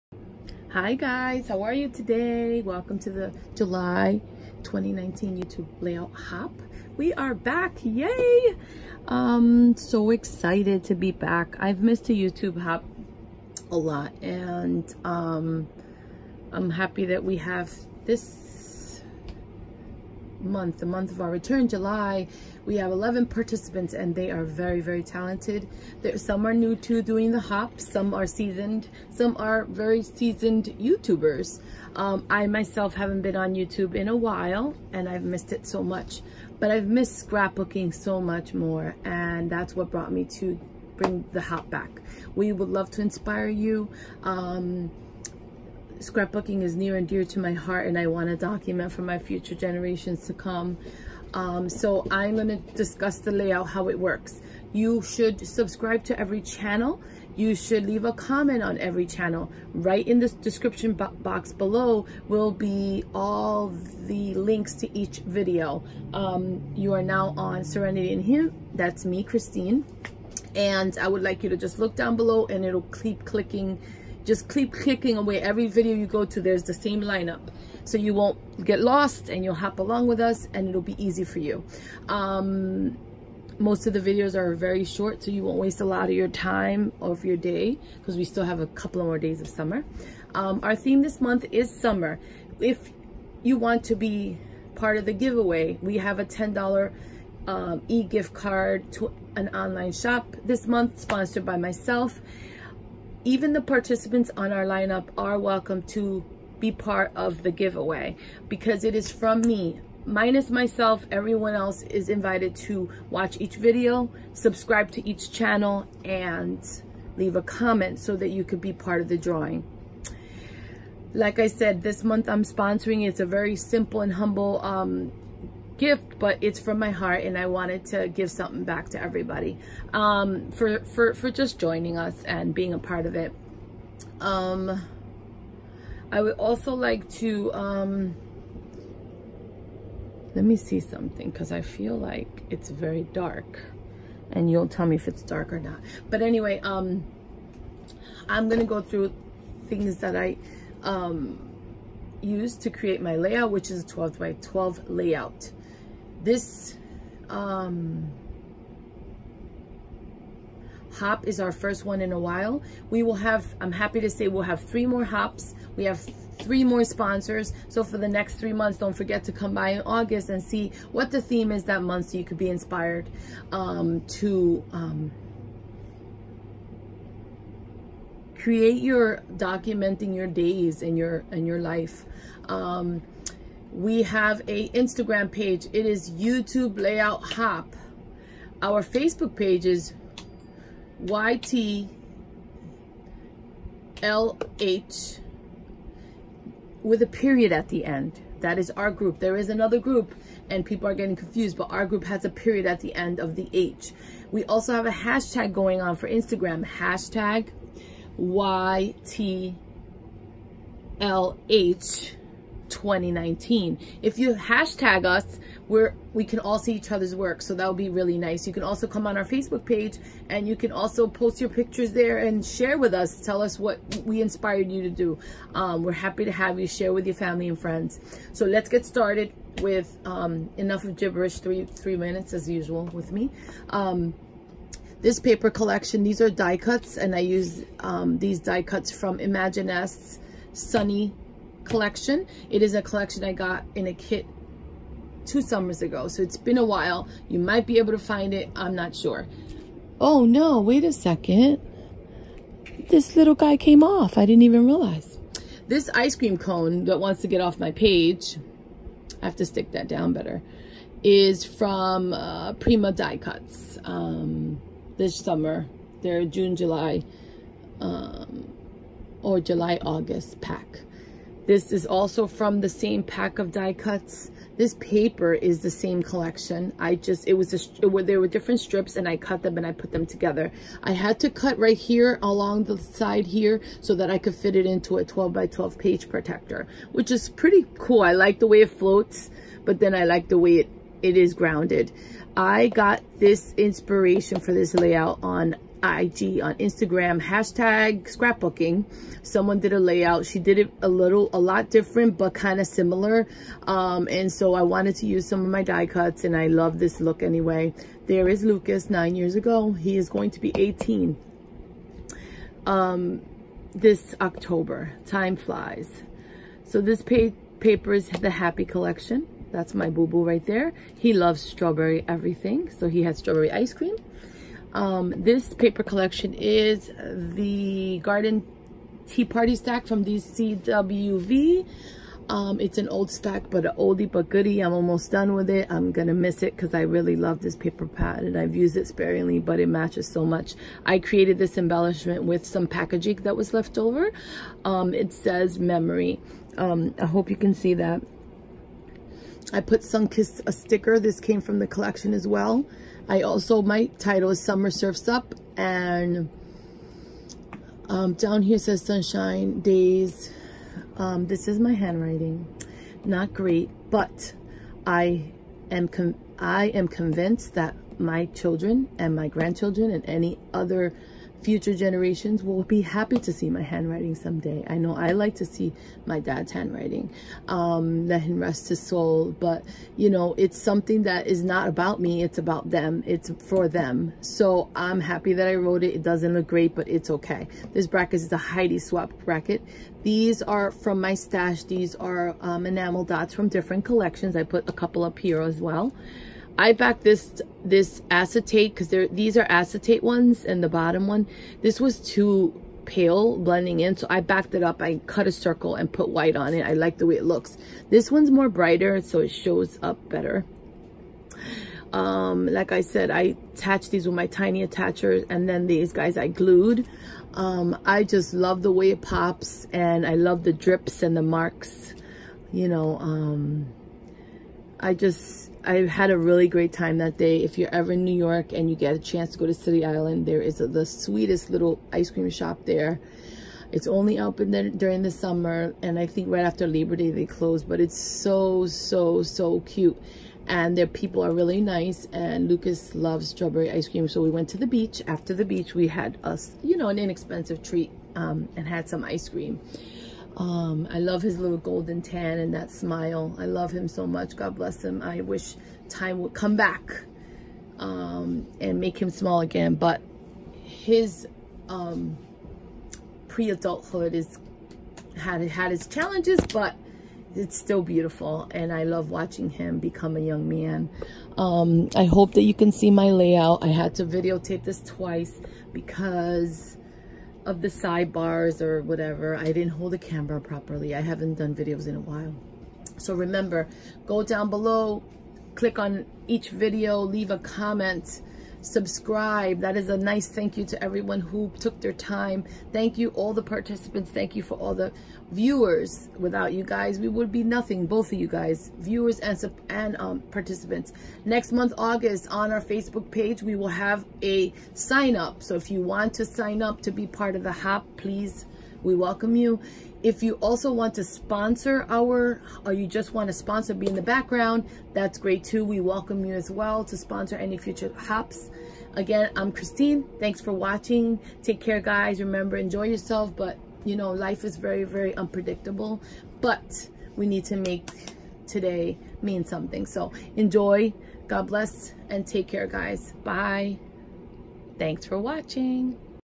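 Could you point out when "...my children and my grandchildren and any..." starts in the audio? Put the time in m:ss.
6:07.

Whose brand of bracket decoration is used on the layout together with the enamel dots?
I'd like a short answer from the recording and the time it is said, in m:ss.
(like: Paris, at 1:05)
Heidi Swapp, at 6:28.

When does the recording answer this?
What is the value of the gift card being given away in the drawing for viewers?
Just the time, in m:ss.
1:36.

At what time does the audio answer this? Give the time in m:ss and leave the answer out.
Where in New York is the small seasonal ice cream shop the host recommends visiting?
7:09.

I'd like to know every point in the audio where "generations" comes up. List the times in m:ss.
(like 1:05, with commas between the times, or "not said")
0:49, 6:11.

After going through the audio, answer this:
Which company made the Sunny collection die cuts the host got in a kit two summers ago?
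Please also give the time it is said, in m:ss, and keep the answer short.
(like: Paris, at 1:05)
Imaginisce, at 3:59.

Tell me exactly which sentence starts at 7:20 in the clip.
And their people are really nice, and Lucas loves strawberry ice cream.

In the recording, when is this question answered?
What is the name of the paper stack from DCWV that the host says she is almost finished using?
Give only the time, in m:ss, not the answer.
5:28.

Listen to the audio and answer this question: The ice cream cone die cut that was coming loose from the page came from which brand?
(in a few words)
Prima.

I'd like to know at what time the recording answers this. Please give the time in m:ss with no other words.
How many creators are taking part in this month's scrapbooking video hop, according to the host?
0:22.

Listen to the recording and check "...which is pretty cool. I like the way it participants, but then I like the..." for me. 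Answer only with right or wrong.
wrong.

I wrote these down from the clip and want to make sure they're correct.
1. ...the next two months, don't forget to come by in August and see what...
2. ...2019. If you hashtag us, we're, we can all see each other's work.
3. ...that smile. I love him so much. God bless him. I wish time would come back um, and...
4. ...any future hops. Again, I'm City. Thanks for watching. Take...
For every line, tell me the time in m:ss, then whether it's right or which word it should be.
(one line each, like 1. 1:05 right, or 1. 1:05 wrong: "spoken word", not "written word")
1. 2:47 wrong: "three", not "two"
2. 3:32 right
3. 7:32 right
4. 8:37 wrong: "Christine", not "City".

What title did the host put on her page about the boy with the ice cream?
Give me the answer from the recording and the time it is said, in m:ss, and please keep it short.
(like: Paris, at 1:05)
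Summer Surfs Up, at 5:54.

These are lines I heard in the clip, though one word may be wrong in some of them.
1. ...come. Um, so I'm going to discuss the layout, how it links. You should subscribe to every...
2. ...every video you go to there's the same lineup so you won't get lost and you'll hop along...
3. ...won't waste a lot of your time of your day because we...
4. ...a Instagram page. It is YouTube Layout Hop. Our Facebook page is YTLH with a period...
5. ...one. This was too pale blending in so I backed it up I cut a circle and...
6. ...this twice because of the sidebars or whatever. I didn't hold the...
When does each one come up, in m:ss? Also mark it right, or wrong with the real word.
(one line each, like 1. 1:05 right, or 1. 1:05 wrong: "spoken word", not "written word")
1. 0:50 wrong: "works", not "links"
2. 1:15 right
3. 1:25 right
4. 3:04 right
5. 6:41 right
6. 7:54 right.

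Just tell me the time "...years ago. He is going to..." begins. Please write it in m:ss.
5:09.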